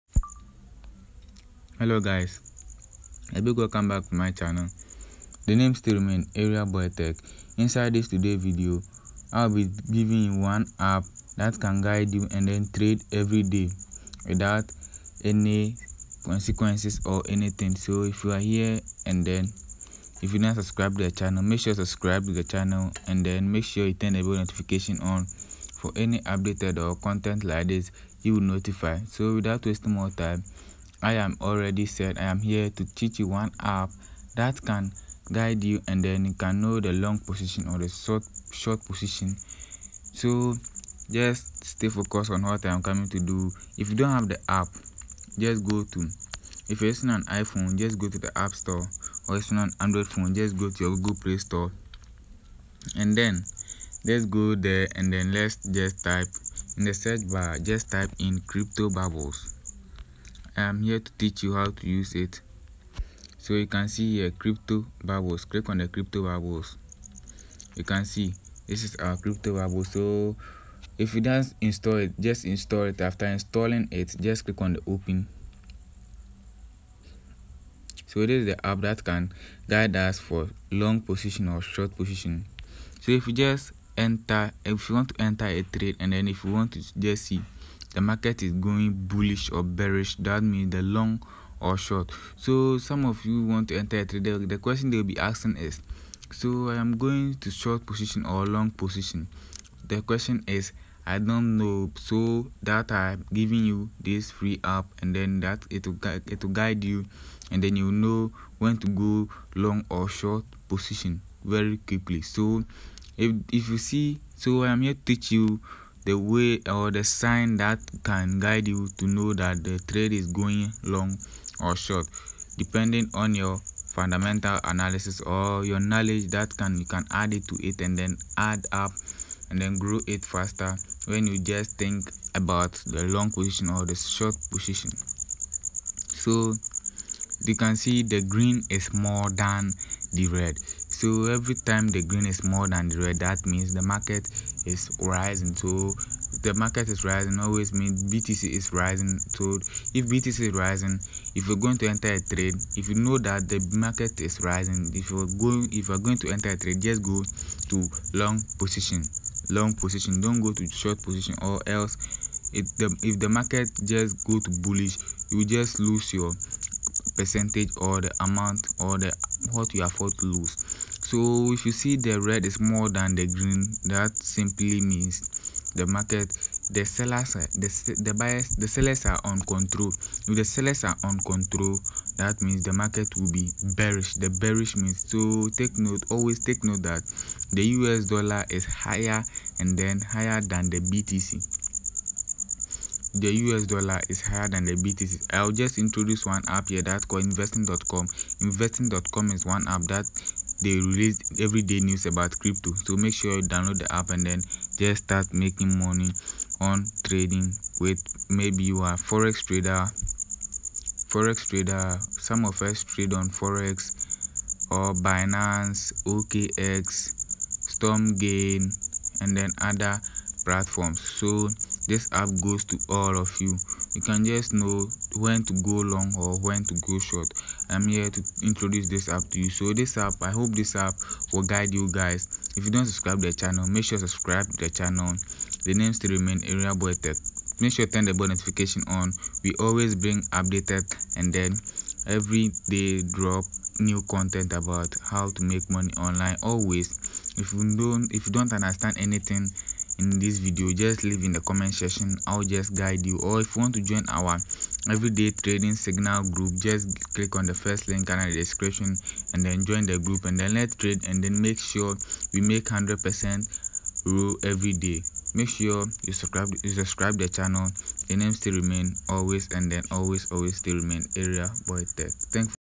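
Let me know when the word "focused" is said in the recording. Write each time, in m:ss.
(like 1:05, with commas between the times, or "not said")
0:41.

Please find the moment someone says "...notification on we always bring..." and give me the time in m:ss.
3:58.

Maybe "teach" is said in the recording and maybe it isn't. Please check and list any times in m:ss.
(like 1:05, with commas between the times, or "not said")
0:32, 1:01, 1:55.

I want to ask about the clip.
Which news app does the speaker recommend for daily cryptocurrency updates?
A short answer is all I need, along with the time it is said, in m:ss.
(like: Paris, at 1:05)
investing.com, at 3:18.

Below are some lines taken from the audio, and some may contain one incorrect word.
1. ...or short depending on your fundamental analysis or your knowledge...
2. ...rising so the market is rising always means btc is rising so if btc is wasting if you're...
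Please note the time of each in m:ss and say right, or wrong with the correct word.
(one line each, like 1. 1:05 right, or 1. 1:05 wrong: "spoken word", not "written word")
1. 2:01 right
2. 2:25 wrong: "rising", not "wasting".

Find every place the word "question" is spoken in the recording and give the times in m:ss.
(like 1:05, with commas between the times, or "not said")
1:34, 1:40.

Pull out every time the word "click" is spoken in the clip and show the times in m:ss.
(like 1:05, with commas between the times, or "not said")
1:05, 1:14, 4:17.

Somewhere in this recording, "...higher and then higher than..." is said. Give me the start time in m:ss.
3:08.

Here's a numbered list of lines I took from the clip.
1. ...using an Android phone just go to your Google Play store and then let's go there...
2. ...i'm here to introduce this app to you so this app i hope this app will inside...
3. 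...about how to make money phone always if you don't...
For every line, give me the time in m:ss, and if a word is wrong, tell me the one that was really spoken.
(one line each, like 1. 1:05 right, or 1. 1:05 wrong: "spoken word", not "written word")
1. 0:49 right
2. 3:47 wrong: "guide", not "inside"
3. 4:04 wrong: "online", not "phone".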